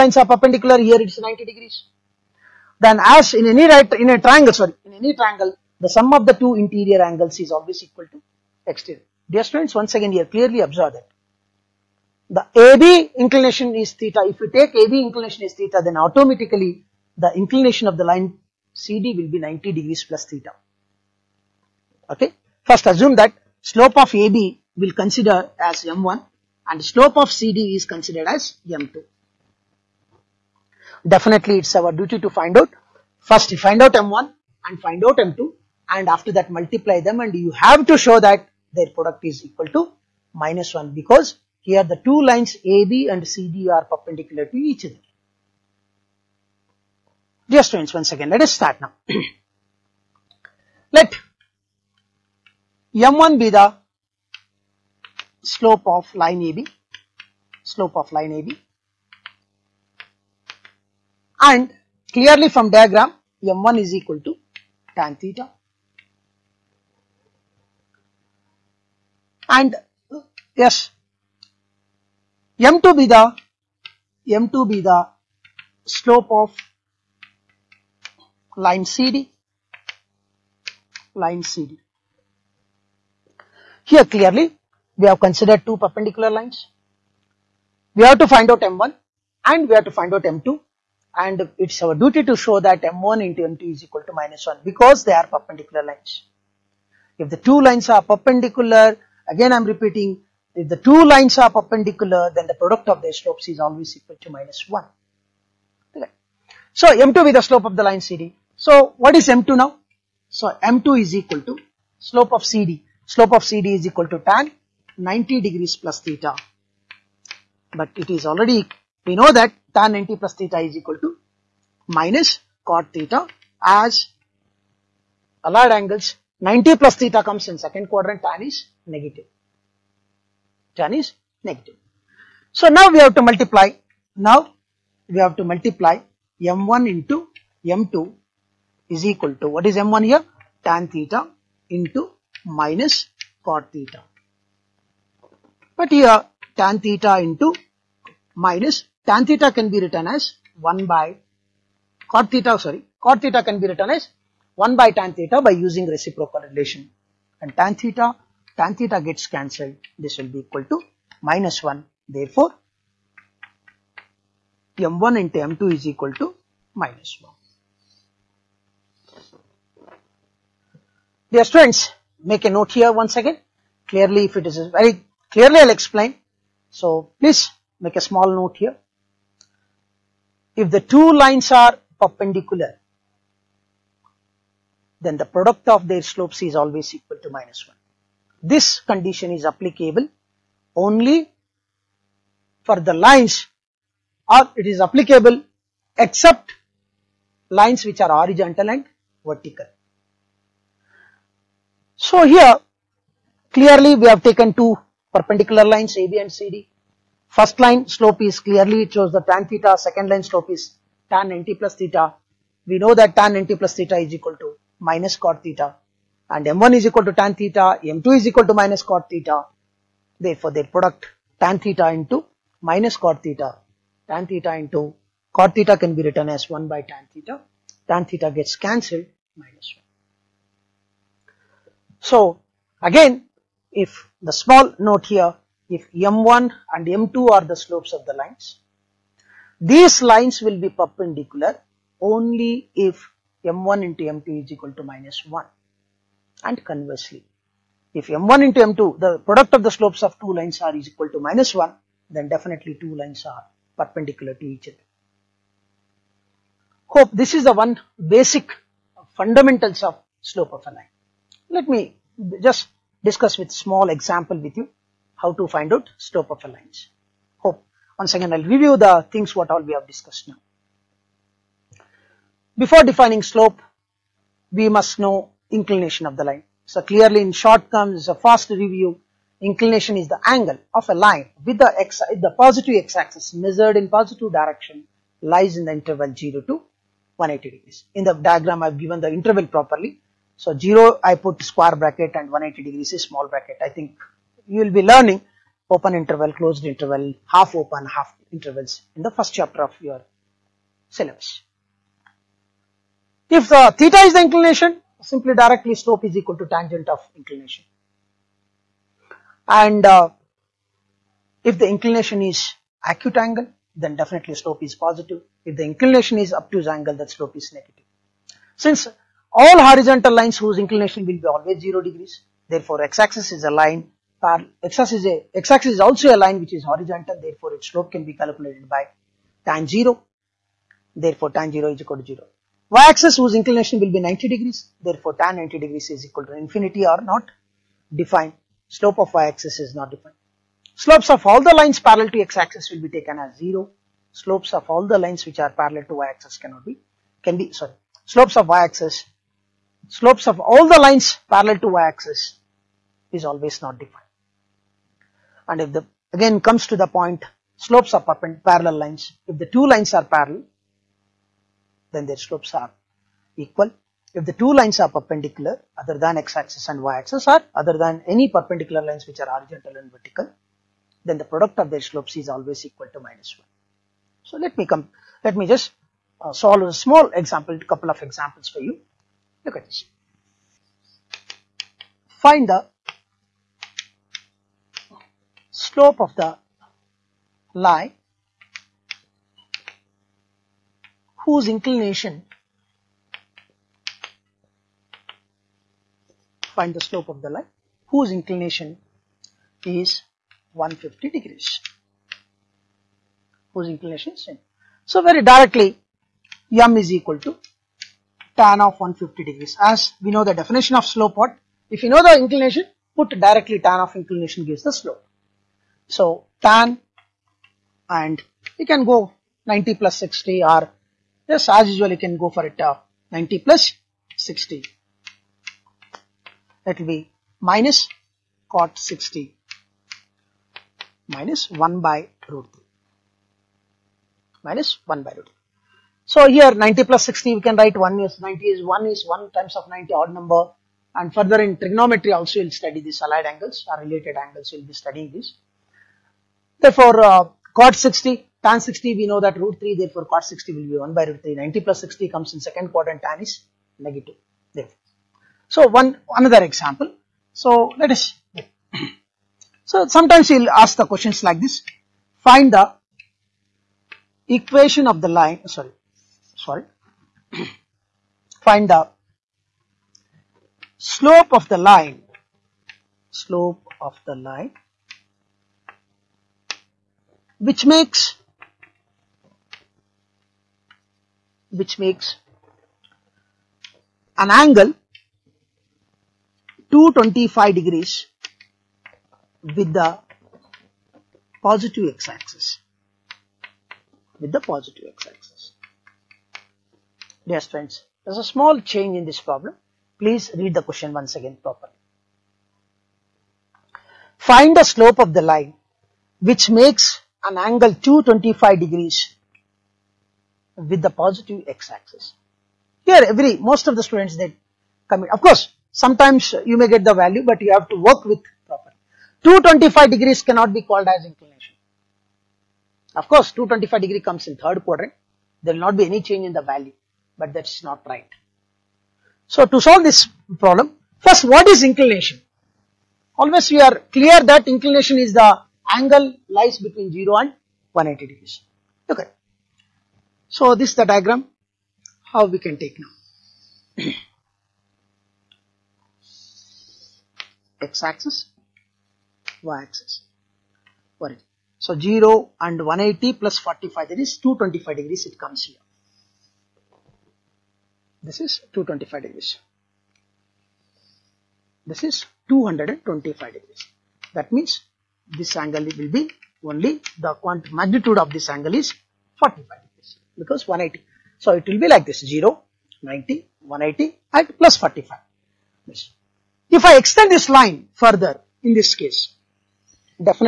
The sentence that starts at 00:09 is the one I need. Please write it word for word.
Dear students, once again, here clearly observed that the AB inclination is theta.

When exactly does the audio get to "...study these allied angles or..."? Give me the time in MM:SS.
07:22.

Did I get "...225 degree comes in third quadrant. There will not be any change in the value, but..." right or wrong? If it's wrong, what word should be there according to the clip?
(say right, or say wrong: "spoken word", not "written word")
right.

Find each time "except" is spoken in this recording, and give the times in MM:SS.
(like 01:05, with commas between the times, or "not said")
03:15.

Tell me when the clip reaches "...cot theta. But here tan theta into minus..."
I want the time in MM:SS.
02:23.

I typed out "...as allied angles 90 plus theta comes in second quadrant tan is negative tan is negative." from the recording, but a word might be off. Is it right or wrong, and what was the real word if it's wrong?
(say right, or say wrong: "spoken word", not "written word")
right.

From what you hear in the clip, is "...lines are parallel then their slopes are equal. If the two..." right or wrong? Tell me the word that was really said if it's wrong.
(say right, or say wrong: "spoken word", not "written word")
right.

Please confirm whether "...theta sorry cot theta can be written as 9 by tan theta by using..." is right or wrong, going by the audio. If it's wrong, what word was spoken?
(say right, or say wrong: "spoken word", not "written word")
wrong: "1", not "9".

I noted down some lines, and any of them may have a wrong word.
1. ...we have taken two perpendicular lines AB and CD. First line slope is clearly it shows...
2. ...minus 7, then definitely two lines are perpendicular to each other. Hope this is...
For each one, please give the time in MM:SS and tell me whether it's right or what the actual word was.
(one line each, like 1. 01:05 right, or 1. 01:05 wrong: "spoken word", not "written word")
1. 03:23 right
2. 04:11 wrong: "1", not "7".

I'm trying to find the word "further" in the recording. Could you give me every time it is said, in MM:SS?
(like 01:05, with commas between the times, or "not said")
07:21, 09:37.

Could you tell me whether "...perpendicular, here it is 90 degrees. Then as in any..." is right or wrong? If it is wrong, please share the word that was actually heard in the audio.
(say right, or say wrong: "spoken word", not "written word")
right.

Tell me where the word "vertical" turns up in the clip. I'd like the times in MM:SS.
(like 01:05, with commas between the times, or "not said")
03:19, 06:09.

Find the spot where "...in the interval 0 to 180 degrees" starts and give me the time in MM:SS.
04:45.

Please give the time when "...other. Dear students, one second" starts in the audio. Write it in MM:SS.
00:44.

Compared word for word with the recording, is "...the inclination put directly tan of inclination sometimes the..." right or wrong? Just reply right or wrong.
wrong.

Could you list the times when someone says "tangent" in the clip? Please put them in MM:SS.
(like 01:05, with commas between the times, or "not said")
05:06.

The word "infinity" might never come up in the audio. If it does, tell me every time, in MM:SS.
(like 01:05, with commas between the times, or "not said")
05:36.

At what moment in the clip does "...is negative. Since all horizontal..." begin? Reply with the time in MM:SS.
05:17.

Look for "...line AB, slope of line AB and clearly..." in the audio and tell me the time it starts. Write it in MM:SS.
00:56.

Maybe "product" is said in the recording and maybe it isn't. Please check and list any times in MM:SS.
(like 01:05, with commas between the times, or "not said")
00:38, 01:42, 03:05, 03:40, 04:09, 06:11.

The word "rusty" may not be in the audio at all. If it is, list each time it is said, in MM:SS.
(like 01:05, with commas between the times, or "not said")
not said.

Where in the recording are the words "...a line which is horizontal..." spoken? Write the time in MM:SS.
05:26.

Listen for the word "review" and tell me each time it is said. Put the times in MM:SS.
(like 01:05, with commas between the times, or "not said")
04:28, 04:38.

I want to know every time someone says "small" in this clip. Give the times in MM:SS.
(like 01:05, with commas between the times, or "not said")
02:58, 03:54, 04:23, 04:53, 06:16, 08:18.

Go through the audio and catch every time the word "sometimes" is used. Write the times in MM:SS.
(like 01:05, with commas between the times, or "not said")
07:39, 08:35.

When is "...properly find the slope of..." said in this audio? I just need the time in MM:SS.
08:21.